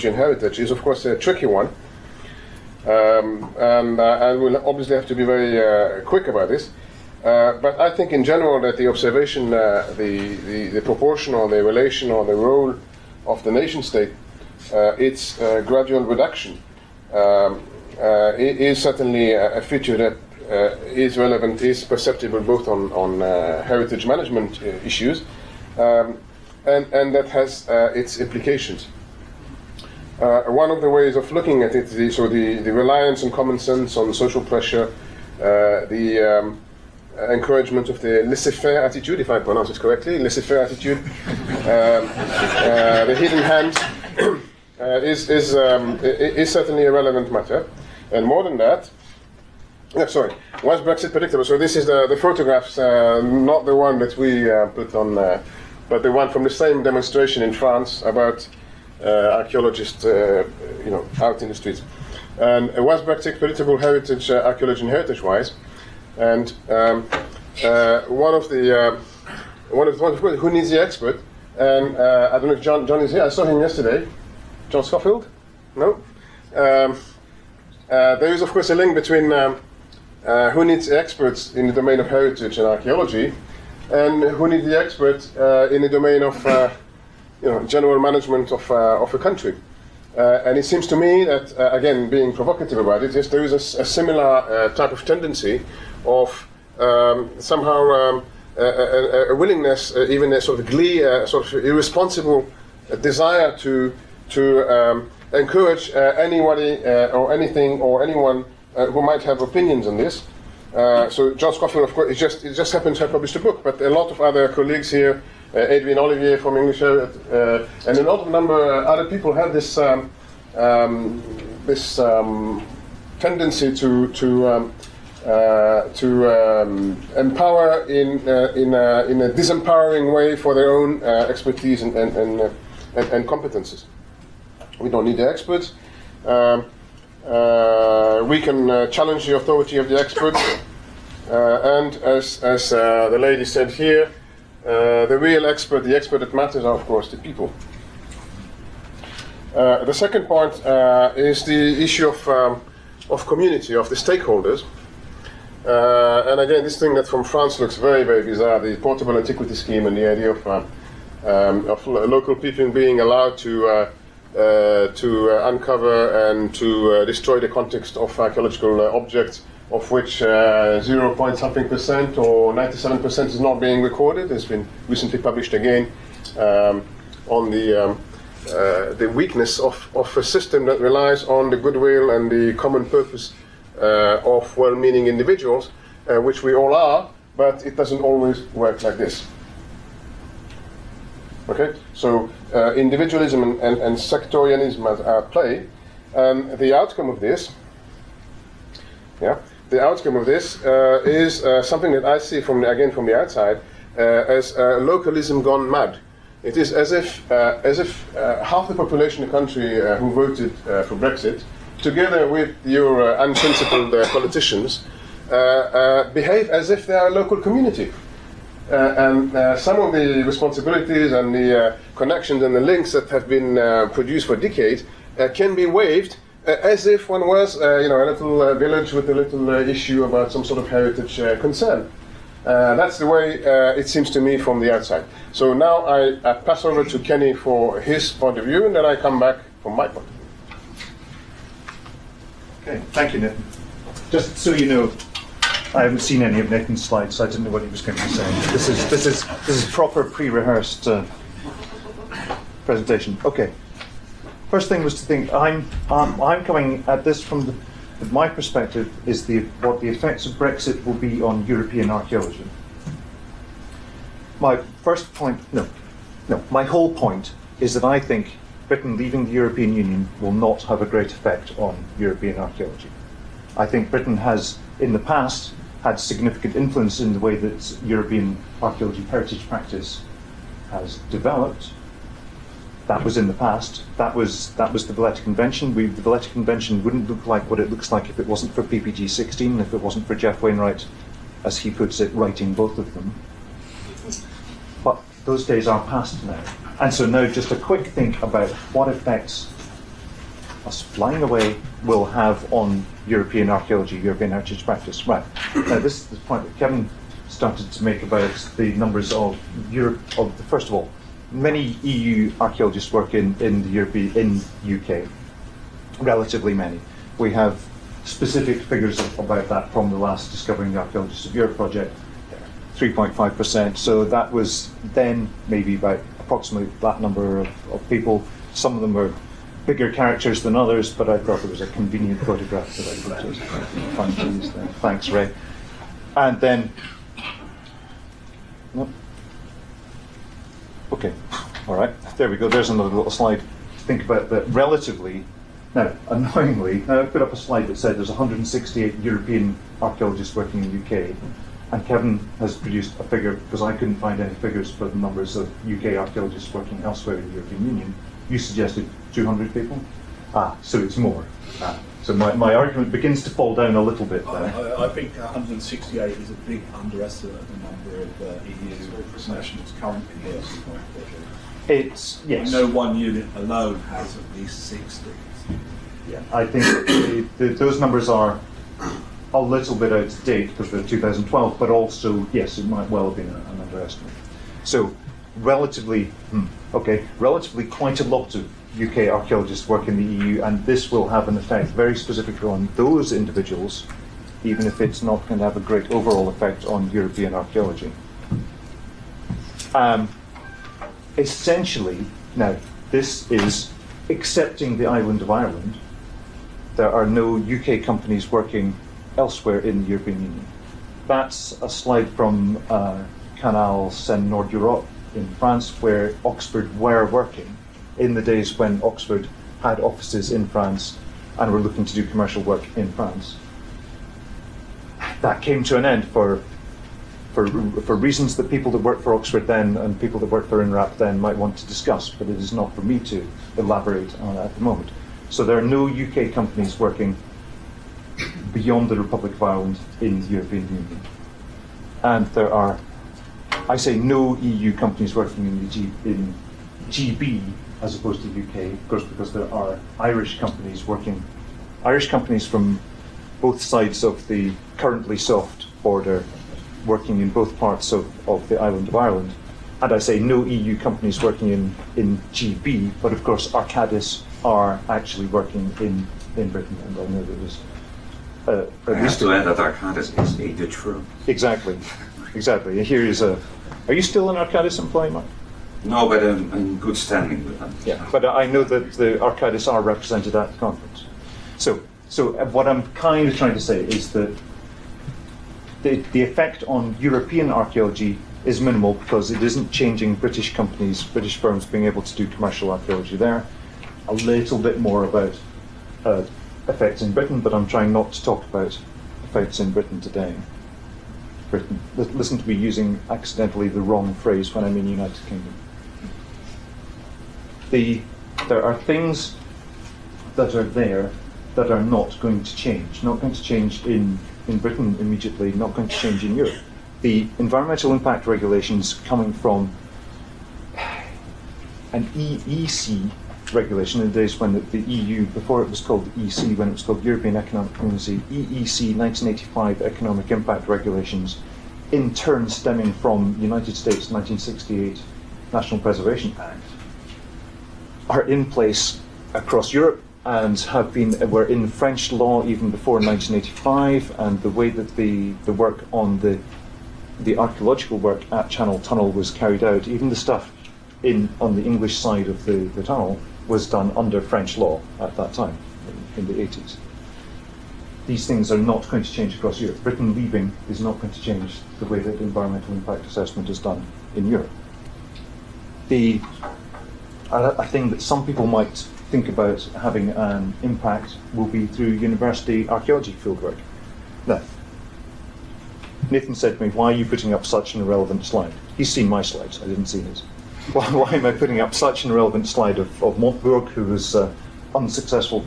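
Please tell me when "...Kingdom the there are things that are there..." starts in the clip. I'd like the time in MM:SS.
08:25.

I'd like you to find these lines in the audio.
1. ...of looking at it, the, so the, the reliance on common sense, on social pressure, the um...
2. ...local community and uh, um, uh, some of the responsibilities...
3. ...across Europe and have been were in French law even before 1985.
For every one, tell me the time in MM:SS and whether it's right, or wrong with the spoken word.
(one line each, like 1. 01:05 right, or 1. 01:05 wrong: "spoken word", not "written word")
1. 00:31 right
2. 03:37 right
3. 08:59 right.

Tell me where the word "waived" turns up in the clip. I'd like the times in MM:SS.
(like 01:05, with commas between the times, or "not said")
03:45.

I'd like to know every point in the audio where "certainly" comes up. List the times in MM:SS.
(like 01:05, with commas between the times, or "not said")
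00:18, 00:46.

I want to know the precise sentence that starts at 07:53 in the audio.
Are you still an Arcadis employee, Mark?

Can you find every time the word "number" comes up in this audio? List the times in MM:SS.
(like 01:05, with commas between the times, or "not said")
01:58, 05:08, 05:27, 05:54, 06:07, 06:17.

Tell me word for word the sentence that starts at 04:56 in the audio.
And so now just a quick think about what effects us flying away will have on European archaeology, European heritage practice.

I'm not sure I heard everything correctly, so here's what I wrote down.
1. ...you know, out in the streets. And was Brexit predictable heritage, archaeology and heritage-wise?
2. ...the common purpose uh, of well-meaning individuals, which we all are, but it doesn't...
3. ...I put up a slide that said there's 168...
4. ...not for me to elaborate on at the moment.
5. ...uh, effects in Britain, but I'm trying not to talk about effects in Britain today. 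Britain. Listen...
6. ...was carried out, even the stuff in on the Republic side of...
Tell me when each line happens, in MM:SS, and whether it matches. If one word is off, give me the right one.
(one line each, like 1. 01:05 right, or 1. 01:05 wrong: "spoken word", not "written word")
1. 01:00 right
2. 03:02 right
3. 05:47 right
4. 07:12 right
5. 08:16 right
6. 09:09 wrong: "English", not "Republic".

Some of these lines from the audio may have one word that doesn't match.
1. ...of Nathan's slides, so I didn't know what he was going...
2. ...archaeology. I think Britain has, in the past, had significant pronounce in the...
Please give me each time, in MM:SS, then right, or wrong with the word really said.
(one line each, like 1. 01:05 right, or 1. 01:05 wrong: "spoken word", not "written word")
1. 04:06 right
2. 04:32 wrong: "influence", not "pronounce".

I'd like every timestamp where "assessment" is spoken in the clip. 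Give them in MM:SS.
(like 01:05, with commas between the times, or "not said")
09:23.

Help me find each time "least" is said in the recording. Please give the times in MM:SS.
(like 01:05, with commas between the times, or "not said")
06:14, 07:49.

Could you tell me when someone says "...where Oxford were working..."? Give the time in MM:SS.
06:55.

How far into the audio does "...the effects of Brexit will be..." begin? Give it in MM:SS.
04:19.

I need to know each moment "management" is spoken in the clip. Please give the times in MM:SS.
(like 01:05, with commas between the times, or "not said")
00:24, 01:27.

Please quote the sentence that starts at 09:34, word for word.
Now, Nathan said to me, why are you putting up such an irrelevant slide?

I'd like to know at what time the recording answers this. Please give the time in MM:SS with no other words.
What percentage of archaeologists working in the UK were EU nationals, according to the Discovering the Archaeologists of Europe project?
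05:22.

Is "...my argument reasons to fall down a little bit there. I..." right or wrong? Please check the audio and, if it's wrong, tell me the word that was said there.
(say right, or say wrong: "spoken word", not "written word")
wrong: "begins", not "reasons".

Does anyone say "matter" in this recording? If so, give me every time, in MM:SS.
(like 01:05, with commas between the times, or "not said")
00:47, 02:26.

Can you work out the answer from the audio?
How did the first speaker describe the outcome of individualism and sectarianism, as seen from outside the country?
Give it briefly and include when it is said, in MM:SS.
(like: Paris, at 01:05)
localism gone mad, at 03:24.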